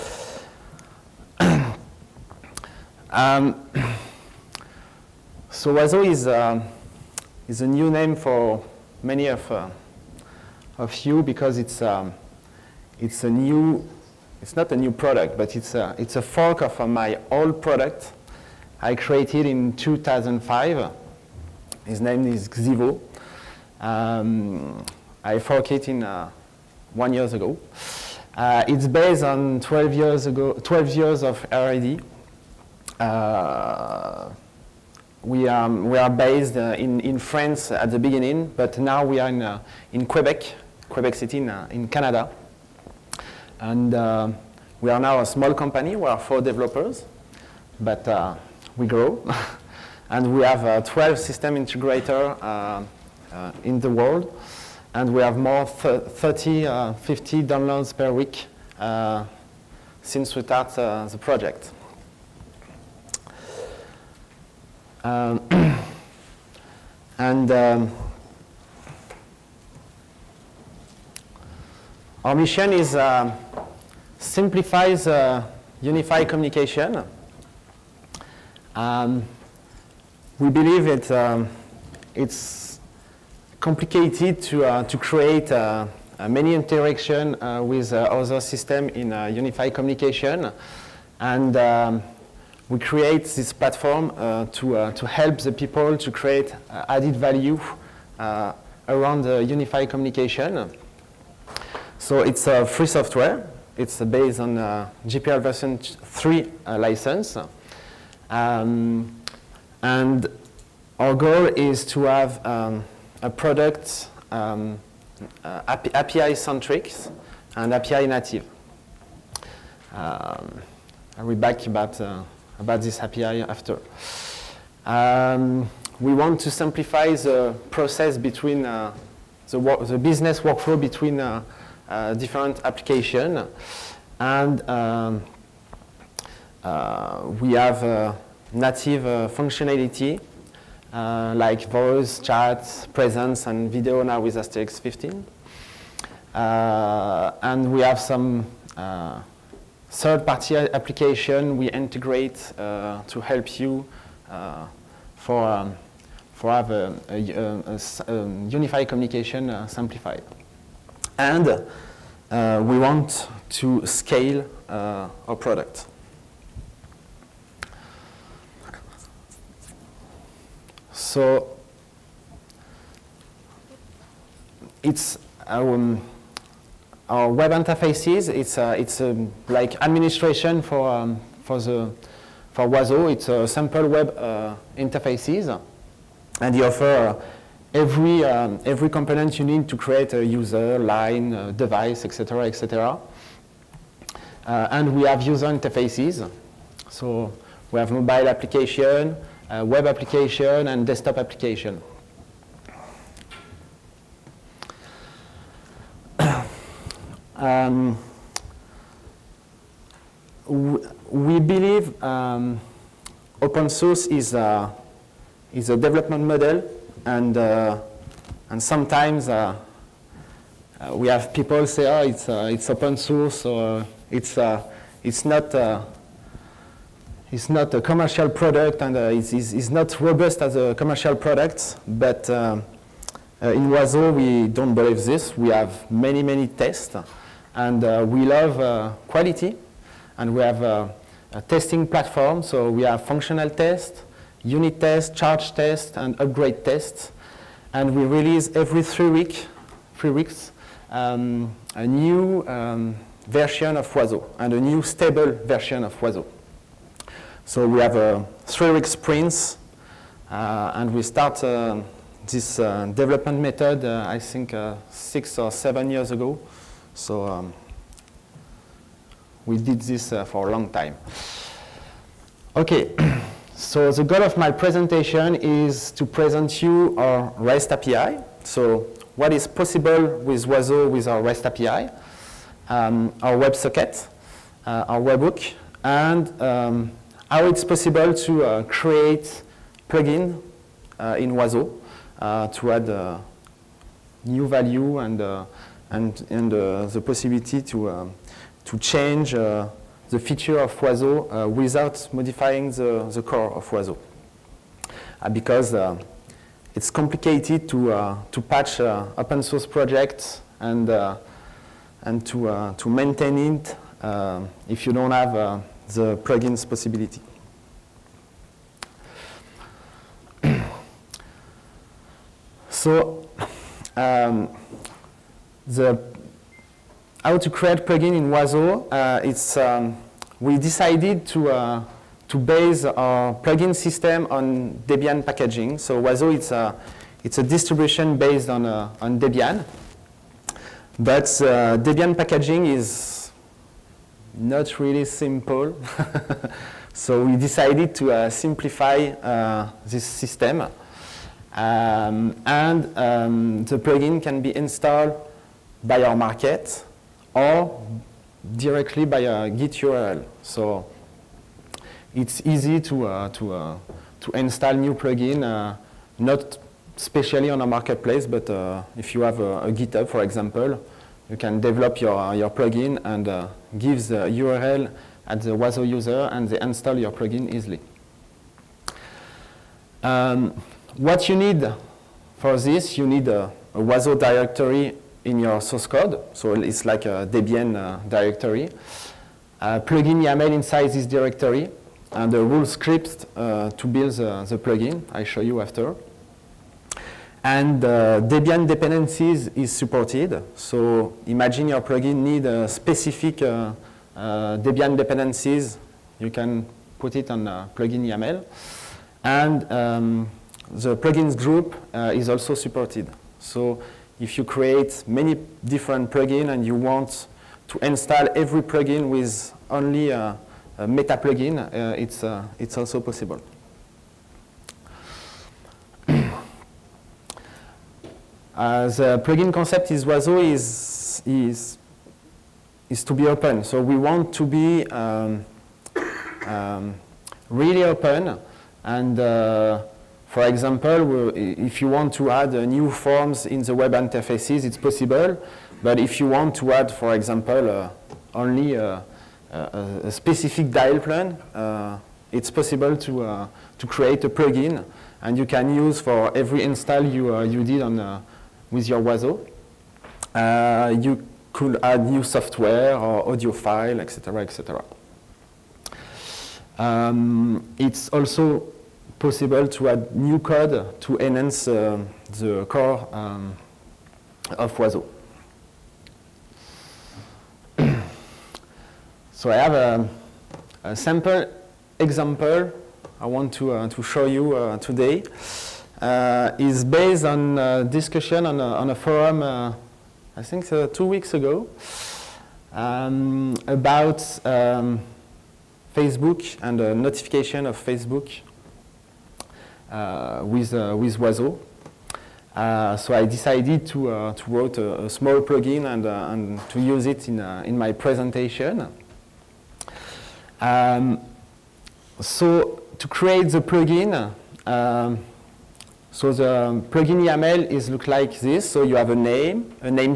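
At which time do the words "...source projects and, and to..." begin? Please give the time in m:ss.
5:09.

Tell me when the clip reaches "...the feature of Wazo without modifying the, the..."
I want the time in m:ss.
4:59.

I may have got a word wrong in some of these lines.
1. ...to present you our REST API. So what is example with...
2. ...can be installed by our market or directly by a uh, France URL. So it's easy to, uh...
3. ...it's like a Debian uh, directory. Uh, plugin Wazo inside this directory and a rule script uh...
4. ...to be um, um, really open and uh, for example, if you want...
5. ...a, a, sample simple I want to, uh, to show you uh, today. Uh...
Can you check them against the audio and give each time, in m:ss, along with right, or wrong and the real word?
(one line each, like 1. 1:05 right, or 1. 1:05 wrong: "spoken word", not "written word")
1. 4:35 wrong: "possible", not "example"
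2. 5:54 wrong: "Git", not "France"
3. 6:26 wrong: "YAML", not "Wazo"
4. 7:14 right
5. 7:59 wrong: "example", not "simple".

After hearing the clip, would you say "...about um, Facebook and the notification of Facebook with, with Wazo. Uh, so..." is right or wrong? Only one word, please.
right.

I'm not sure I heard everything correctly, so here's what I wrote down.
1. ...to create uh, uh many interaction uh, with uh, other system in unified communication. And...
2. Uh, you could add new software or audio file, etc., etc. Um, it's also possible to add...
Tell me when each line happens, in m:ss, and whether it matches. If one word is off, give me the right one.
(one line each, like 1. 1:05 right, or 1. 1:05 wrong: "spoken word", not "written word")
1. 1:24 right
2. 7:40 right.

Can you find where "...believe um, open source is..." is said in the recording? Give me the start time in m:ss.
3:31.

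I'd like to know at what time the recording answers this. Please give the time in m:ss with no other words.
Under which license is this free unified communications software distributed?
1:45.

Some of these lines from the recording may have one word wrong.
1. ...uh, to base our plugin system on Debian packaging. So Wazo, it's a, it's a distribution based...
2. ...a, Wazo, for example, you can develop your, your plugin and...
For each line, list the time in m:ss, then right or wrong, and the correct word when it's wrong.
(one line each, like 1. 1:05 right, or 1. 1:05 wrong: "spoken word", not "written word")
1. 5:31 right
2. 6:09 wrong: "GitHub", not "Wazo".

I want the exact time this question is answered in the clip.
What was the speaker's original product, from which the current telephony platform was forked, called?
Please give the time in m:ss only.
0:22.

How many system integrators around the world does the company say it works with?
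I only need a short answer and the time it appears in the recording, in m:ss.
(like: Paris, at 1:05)
12, at 0:50.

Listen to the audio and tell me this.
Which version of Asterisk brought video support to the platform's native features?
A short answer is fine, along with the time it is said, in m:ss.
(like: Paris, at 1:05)
Asterisk 15, at 2:24.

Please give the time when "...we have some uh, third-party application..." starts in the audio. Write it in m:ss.
2:27.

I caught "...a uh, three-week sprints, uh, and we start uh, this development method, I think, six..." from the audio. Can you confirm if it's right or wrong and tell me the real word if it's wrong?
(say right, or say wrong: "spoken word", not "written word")
right.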